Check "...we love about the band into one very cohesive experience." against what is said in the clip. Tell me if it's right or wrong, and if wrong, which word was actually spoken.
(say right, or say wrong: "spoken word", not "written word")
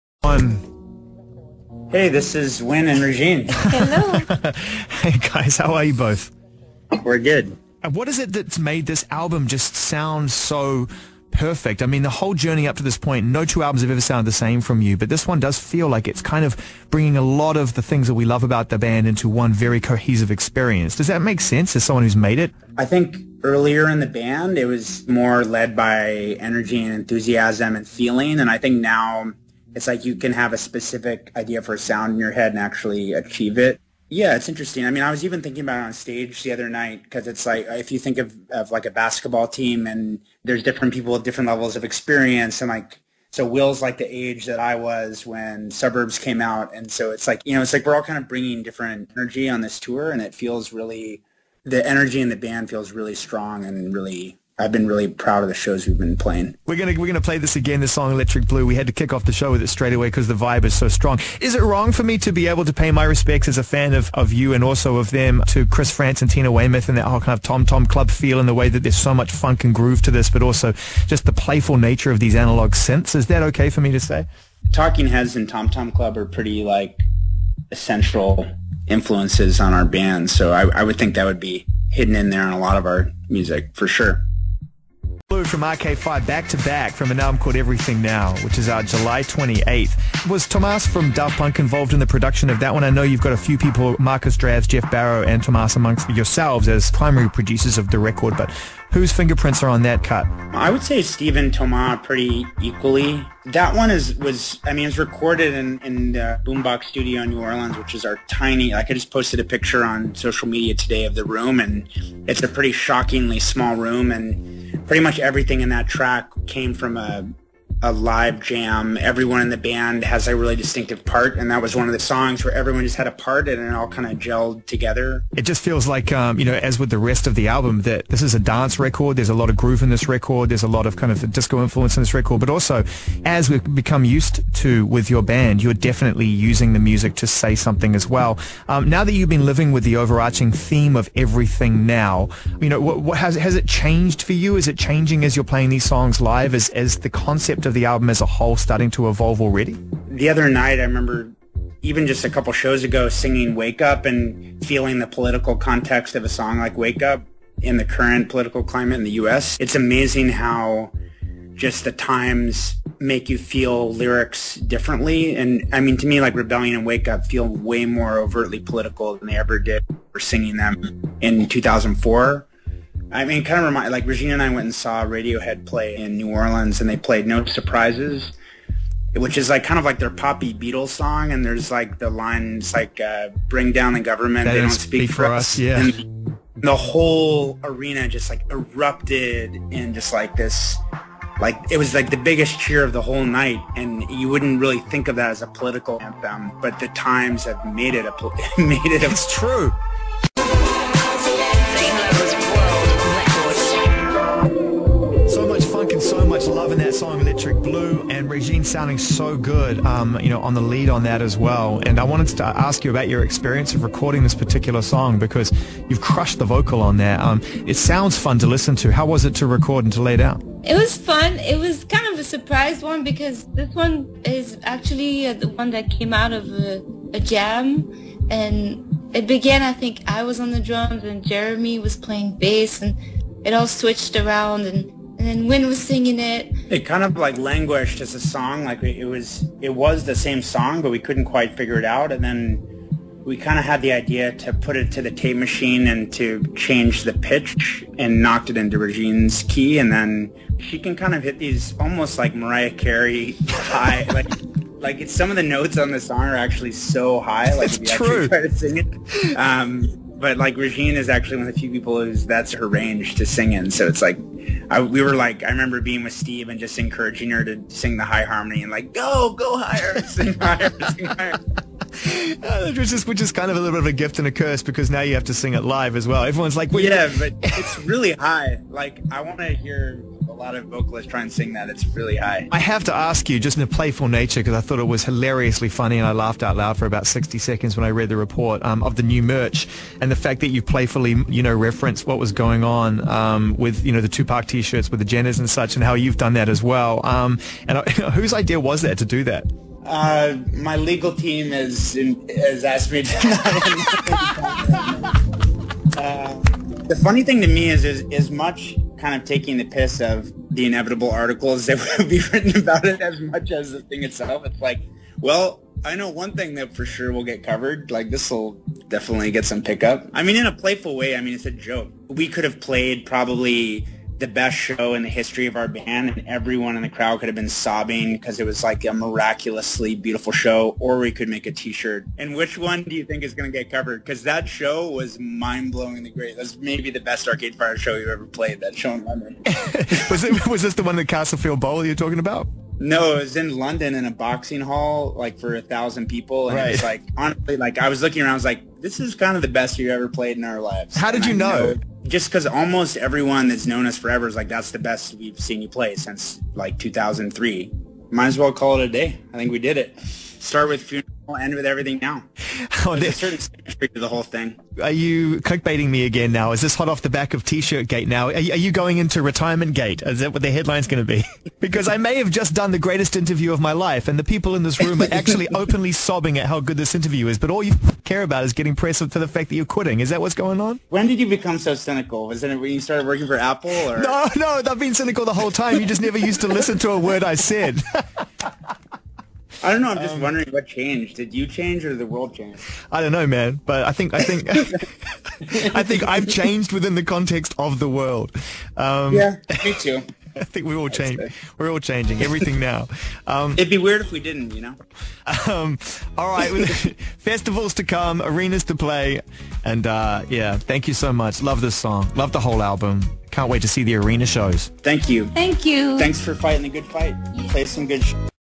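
right.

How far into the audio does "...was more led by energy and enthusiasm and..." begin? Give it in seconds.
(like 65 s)
24 s.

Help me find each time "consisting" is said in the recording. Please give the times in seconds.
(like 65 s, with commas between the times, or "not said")
not said.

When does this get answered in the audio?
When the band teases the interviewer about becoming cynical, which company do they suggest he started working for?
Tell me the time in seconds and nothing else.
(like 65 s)
383 s.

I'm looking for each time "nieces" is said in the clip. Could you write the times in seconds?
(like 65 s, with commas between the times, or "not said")
not said.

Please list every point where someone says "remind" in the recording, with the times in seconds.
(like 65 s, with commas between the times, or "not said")
173 s.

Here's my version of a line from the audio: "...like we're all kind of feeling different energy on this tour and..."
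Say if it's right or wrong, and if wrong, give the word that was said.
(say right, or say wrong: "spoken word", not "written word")
wrong: "bringing", not "feeling".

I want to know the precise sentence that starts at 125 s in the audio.
It just feels like, um, you know, as with the rest of the album, that this is a dance record.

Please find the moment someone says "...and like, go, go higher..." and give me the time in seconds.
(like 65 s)
268 s.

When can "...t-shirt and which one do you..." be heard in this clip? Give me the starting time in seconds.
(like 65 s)
331 s.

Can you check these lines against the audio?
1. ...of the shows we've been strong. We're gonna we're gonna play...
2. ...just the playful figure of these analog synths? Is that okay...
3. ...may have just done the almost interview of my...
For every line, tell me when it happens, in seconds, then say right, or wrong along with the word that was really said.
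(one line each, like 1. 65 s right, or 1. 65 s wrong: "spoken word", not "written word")
1. 55 s wrong: "playing", not "strong"
2. 71 s wrong: "nature", not "figure"
3. 371 s wrong: "greatest", not "almost".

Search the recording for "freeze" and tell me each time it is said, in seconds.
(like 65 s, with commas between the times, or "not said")
not said.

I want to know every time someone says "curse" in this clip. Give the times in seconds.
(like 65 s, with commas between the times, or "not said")
274 s.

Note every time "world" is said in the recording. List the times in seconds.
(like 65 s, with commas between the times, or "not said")
392 s, 397 s.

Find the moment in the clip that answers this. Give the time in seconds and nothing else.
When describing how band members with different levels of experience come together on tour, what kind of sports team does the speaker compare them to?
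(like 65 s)
38 s.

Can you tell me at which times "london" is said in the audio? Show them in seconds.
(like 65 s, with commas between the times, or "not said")
339 s, 343 s.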